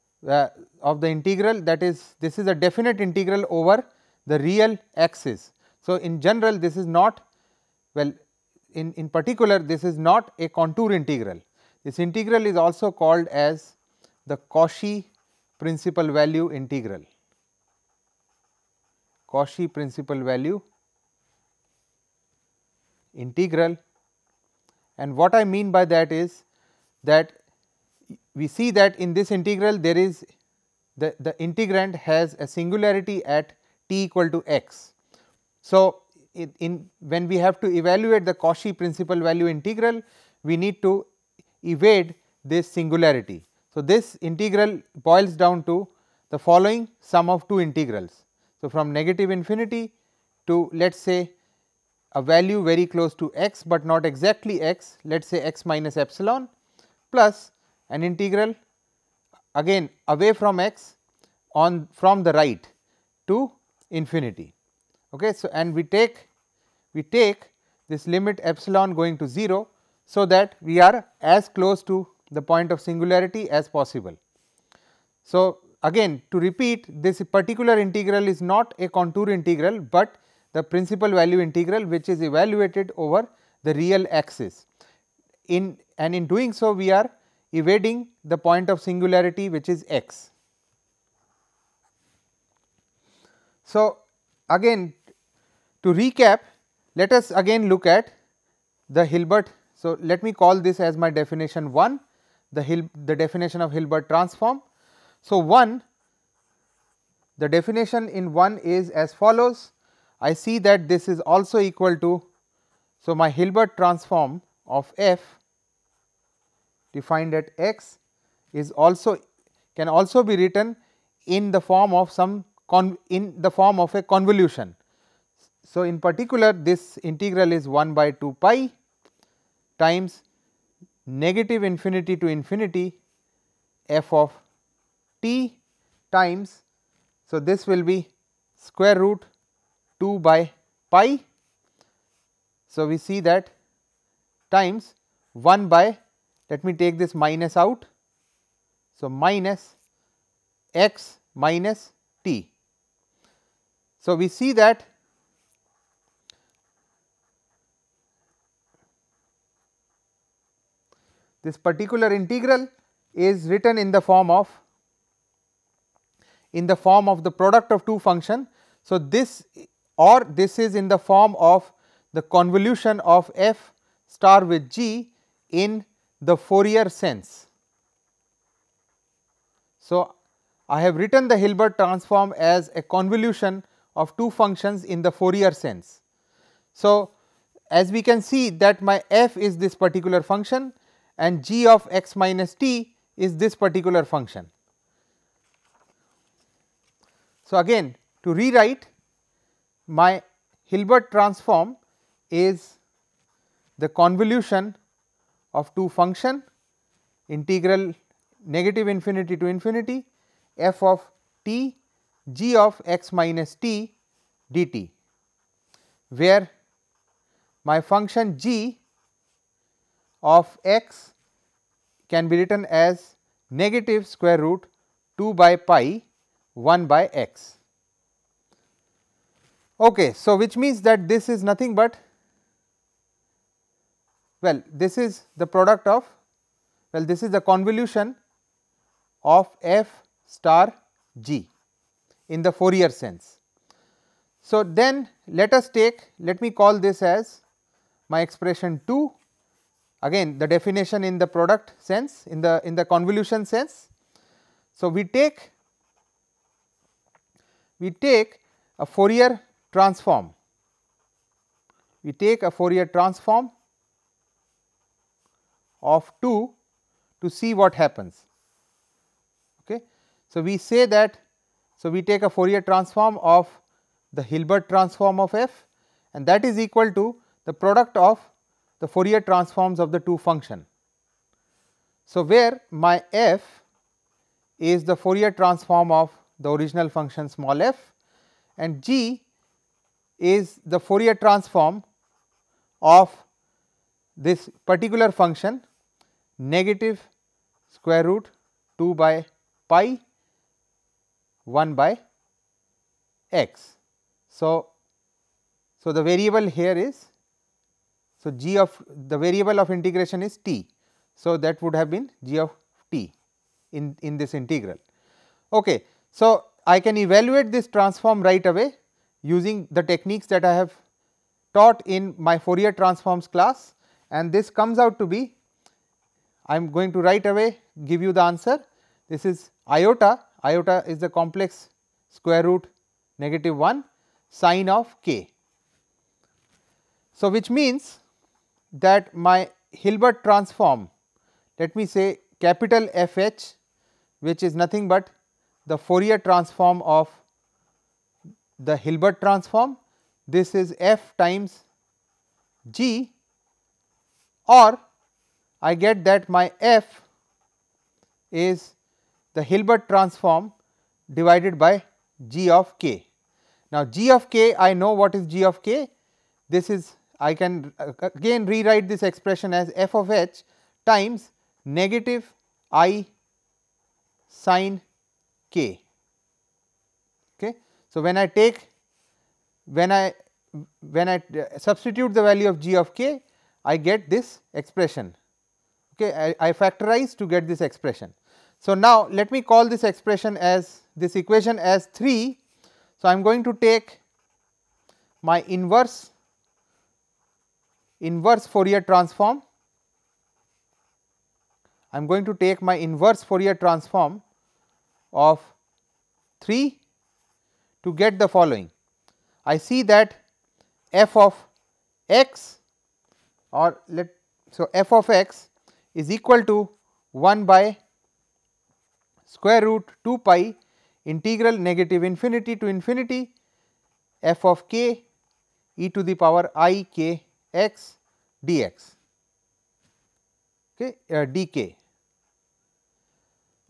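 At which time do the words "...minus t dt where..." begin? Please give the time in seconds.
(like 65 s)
213 s.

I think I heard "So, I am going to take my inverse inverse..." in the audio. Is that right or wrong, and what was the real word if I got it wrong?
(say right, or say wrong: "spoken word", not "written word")
right.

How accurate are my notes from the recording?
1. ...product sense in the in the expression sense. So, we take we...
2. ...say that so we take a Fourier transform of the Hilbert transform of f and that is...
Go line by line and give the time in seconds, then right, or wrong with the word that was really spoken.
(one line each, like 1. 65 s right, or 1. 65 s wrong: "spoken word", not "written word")
1. 251 s wrong: "convolution", not "expression"
2. 270 s right.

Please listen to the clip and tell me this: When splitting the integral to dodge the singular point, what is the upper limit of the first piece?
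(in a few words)
x minus epsilon.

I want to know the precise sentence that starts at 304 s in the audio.
So, so the variable here is so, g of the variable of integration is t.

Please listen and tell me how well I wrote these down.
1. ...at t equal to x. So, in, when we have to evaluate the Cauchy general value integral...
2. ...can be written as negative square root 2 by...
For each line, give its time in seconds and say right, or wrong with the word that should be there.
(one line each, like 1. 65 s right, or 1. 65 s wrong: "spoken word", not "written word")
1. 33 s wrong: "principal", not "general"
2. 222 s right.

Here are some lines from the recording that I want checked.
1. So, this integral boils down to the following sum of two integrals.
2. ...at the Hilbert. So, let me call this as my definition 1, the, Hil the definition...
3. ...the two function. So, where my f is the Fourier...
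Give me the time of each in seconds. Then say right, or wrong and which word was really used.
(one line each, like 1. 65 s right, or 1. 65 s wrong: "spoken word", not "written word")
1. 43 s right
2. 97 s right
3. 279 s right.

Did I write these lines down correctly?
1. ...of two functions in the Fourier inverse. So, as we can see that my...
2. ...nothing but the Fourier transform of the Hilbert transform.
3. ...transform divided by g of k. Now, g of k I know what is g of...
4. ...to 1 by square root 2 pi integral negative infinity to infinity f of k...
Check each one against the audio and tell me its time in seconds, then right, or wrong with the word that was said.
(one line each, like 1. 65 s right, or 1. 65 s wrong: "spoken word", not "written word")
1. 183 s wrong: "sense", not "inverse"
2. 344 s right
3. 359 s right
4. 416 s right.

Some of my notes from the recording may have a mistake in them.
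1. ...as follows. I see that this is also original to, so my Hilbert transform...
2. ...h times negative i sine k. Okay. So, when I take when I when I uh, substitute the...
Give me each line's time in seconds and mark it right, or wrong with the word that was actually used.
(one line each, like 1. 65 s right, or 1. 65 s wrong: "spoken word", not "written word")
1. 108 s wrong: "equal", not "original"
2. 370 s right.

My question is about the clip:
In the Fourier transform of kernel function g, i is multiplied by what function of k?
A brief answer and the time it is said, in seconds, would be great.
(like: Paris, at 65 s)
sine of k, at 334 s.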